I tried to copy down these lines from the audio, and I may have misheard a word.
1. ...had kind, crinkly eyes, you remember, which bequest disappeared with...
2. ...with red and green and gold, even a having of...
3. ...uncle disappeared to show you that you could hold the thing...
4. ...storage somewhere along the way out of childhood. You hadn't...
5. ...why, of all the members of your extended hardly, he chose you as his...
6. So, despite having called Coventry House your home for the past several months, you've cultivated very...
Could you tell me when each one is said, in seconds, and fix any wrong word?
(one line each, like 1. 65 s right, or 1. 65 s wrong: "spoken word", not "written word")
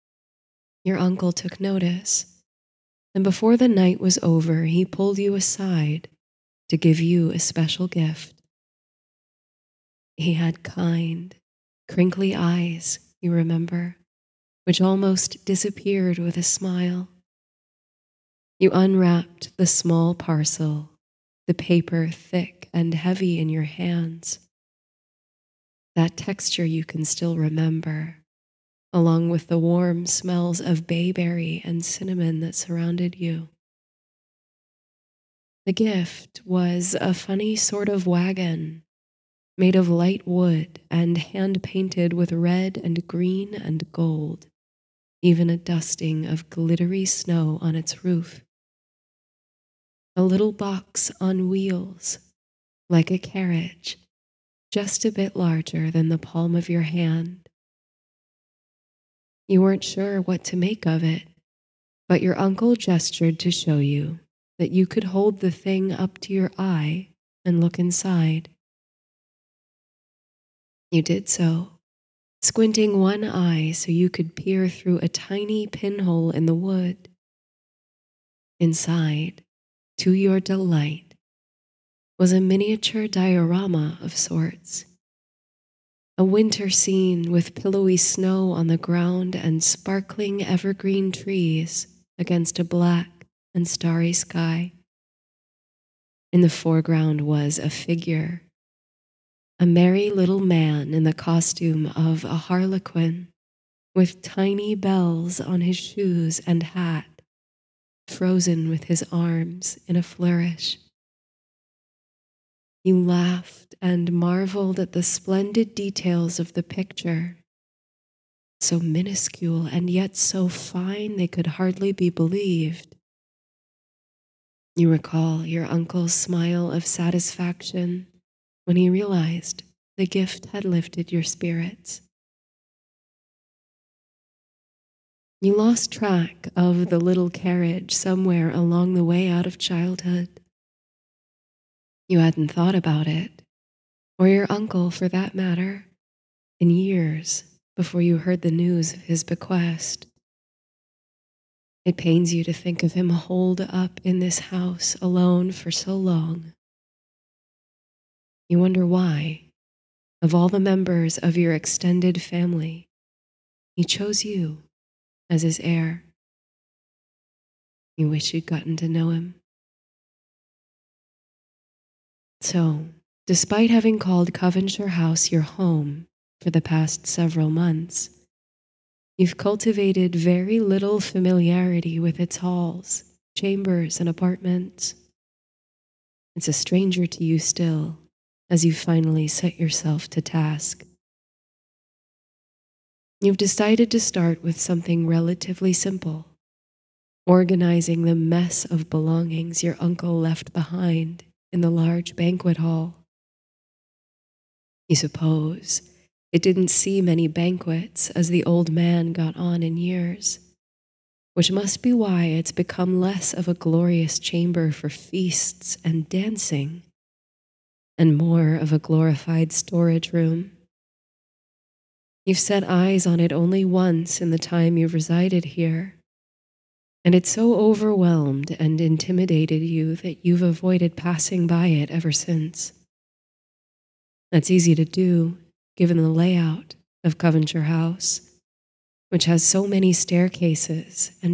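1. 10 s wrong: "almost", not "bequest"
2. 42 s wrong: "dusting", not "having"
3. 62 s wrong: "gestured", not "disappeared"
4. 137 s wrong: "carriage", not "storage"
5. 158 s wrong: "family", not "hardly"
6. 172 s right.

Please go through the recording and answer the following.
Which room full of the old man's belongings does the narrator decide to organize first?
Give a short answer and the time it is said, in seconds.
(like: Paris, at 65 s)
banquet hall, at 202 s.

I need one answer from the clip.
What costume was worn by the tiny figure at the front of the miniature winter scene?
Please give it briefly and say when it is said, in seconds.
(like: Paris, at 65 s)
harlequin, at 102 s.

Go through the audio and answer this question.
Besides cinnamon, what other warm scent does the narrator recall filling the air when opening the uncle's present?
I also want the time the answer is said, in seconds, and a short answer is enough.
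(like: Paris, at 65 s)
bayberry, at 30 s.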